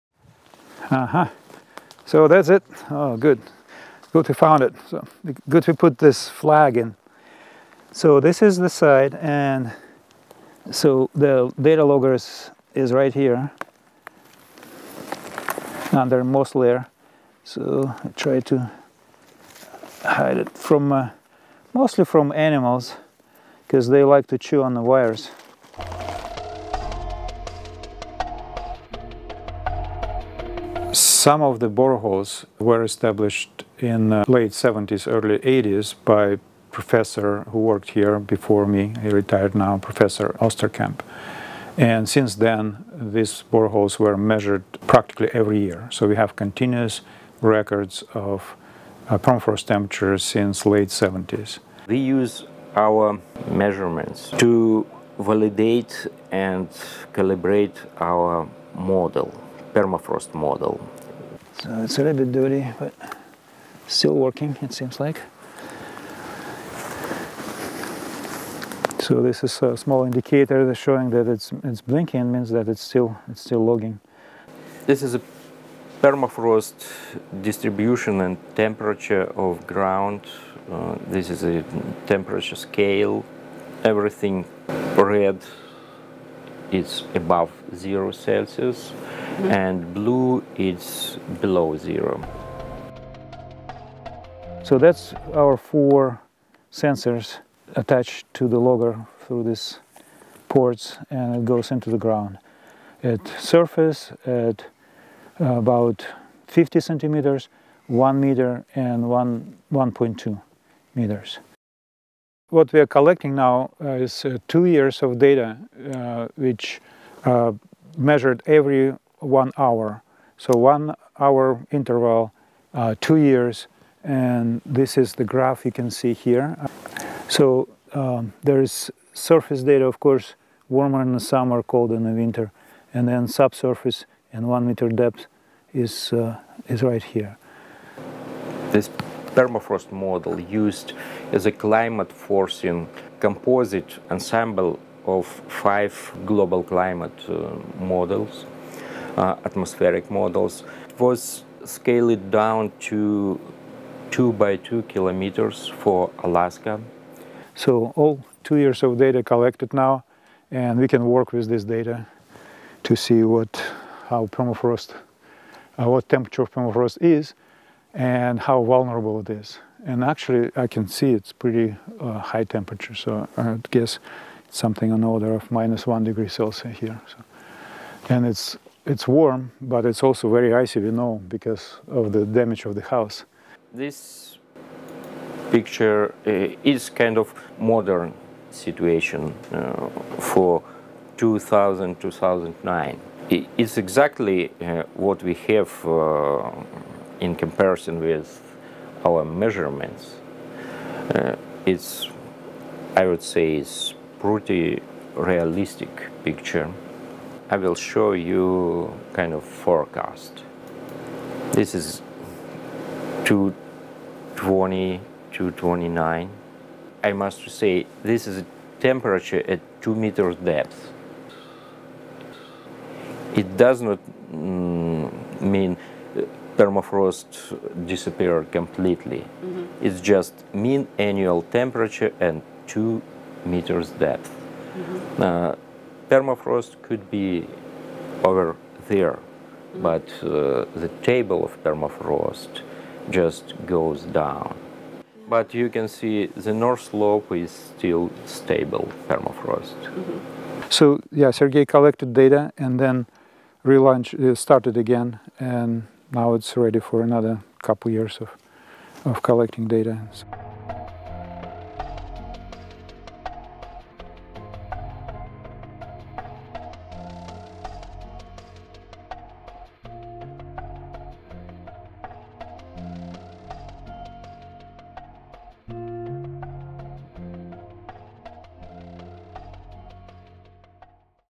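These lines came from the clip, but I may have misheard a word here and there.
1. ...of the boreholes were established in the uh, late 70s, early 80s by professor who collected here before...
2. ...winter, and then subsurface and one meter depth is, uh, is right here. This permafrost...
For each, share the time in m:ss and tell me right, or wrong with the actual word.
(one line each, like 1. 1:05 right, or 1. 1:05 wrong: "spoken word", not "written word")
1. 0:31 wrong: "worked", not "collected"
2. 2:12 right.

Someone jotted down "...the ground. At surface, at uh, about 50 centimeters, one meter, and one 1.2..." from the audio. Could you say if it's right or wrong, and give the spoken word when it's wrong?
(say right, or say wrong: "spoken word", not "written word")
right.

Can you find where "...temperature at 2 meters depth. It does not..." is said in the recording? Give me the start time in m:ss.
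3:38.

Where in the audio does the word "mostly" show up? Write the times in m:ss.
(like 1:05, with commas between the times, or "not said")
0:21.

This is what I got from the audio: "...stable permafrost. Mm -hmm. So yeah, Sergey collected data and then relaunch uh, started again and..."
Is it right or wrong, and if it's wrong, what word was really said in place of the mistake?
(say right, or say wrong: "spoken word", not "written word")
right.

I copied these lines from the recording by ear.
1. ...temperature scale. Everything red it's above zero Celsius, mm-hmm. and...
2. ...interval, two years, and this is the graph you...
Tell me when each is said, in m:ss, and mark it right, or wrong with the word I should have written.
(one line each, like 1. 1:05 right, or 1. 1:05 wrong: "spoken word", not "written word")
1. 1:22 right
2. 2:01 right.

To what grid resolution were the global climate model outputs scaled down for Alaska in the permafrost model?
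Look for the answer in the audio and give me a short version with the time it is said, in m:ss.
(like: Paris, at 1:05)
2 by 2 kilometers, at 2:34.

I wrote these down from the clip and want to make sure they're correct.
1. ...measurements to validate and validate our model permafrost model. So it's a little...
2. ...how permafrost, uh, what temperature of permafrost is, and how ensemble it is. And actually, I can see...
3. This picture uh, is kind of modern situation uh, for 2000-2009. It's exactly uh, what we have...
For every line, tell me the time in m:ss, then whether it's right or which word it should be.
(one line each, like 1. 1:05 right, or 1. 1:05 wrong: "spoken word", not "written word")
1. 0:53 wrong: "calibrate", not "validate"
2. 2:44 wrong: "vulnerable", not "ensemble"
3. 3:03 right.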